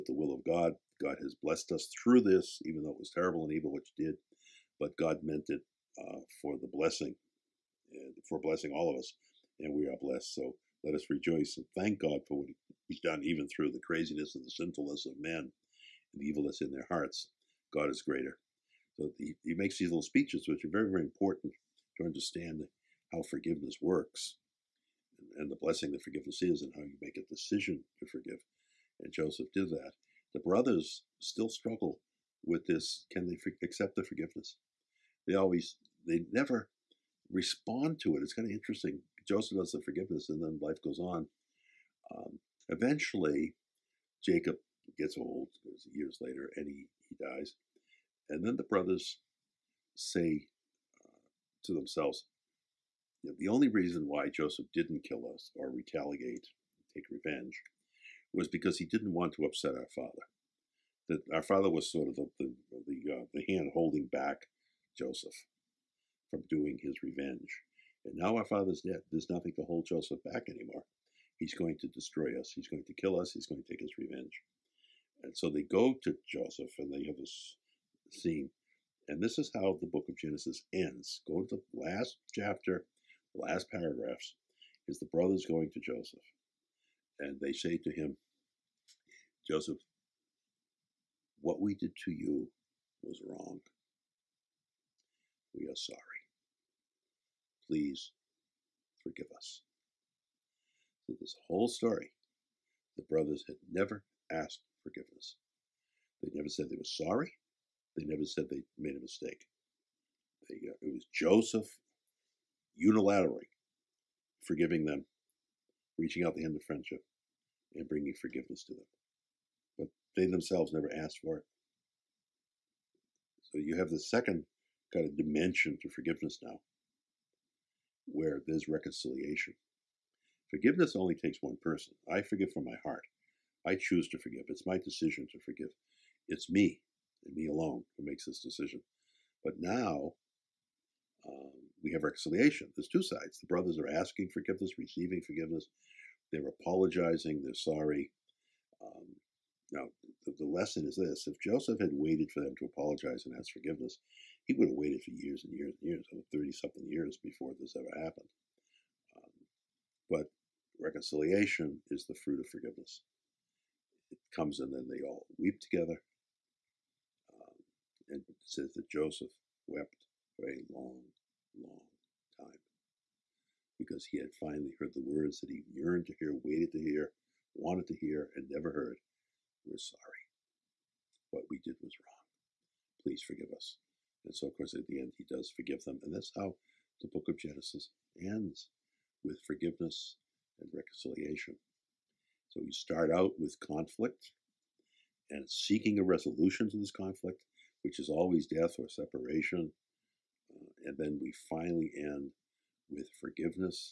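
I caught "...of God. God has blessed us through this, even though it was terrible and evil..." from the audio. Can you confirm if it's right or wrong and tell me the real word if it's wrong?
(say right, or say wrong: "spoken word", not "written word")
right.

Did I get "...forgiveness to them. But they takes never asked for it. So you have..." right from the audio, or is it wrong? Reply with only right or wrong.
wrong.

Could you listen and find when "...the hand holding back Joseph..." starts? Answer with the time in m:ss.
1:03.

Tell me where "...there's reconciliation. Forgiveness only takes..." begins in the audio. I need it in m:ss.
2:08.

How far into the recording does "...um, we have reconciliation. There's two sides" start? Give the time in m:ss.
2:21.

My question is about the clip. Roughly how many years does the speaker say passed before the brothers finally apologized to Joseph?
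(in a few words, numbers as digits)
Over 30.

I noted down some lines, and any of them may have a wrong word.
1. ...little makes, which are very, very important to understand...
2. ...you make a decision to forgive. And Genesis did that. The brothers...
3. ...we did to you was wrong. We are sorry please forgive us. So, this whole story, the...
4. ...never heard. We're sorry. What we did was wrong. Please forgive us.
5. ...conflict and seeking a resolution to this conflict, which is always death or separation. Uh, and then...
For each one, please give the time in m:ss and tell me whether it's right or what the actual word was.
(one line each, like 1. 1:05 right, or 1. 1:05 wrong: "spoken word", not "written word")
1. 0:19 wrong: "speeches", not "makes"
2. 0:26 wrong: "Joseph", not "Genesis"
3. 1:31 right
4. 2:58 right
5. 3:13 right.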